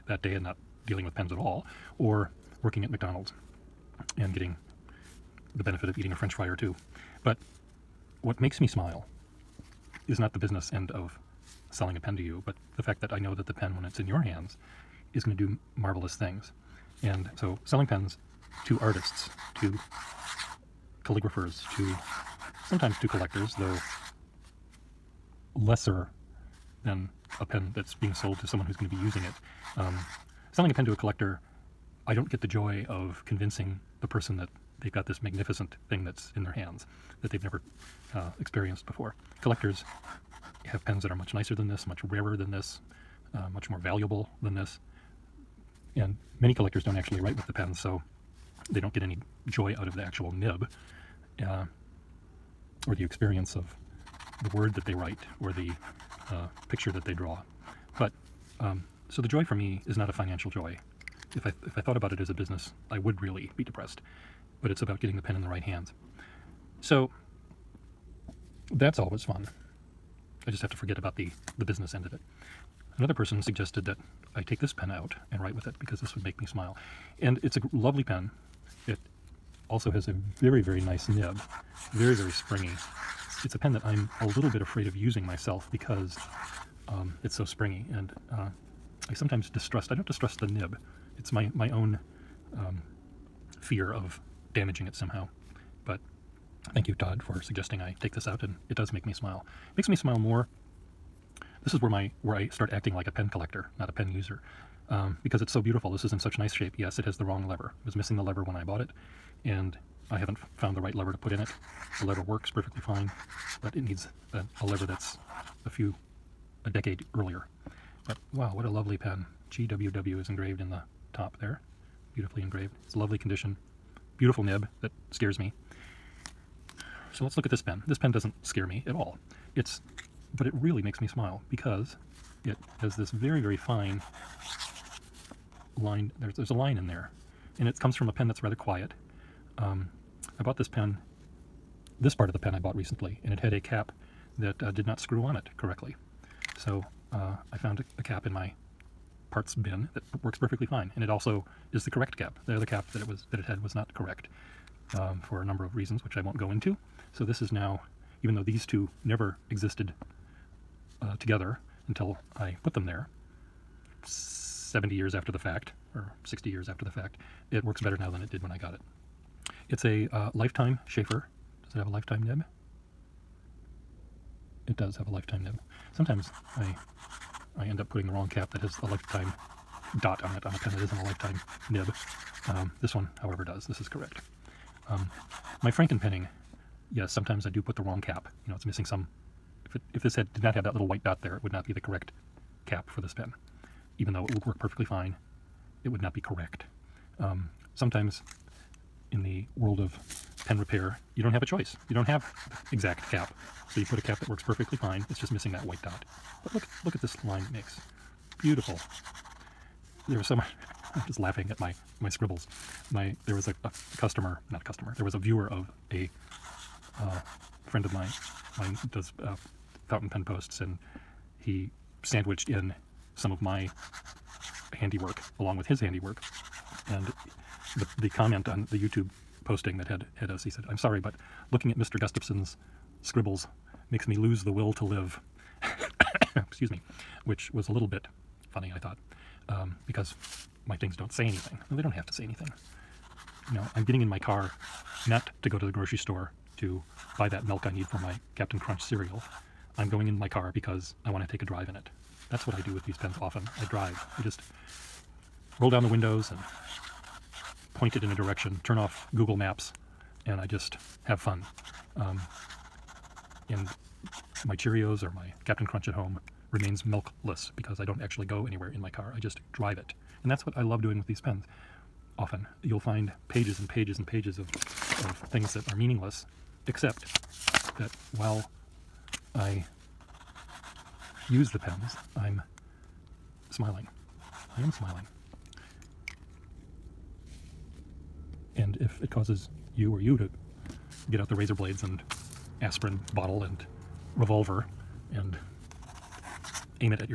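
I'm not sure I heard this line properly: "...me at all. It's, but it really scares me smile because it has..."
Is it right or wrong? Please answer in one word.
wrong.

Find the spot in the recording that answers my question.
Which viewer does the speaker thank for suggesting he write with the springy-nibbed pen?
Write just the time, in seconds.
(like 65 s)
96 s.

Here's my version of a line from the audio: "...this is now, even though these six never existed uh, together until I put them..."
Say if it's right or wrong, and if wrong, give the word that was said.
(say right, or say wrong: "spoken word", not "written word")
wrong: "two", not "six".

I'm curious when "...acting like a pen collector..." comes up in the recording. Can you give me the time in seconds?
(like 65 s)
102 s.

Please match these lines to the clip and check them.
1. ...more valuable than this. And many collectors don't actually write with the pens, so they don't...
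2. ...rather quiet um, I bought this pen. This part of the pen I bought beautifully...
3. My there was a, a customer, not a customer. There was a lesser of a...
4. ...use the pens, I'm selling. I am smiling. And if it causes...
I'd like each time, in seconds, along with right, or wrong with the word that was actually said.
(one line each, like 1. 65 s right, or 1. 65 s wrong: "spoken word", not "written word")
1. 43 s right
2. 138 s wrong: "recently", not "beautifully"
3. 212 s wrong: "viewer", not "lesser"
4. 281 s wrong: "smiling", not "selling".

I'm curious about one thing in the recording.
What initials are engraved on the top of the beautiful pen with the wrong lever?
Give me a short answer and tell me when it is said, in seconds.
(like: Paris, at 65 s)
GWW, at 119 s.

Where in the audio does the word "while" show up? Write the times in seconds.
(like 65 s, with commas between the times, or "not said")
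278 s.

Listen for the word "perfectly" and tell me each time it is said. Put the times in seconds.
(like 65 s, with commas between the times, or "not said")
112 s, 150 s, 194 s, 204 s.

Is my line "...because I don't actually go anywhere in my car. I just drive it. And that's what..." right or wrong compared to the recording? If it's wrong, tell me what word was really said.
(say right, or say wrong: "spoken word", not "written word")
right.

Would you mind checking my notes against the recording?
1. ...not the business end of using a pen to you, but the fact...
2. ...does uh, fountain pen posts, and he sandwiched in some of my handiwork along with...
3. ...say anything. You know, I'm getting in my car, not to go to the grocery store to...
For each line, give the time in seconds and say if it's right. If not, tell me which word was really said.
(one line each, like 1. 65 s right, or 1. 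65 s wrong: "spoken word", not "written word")
1. 10 s wrong: "selling", not "using"
2. 218 s right
3. 242 s right.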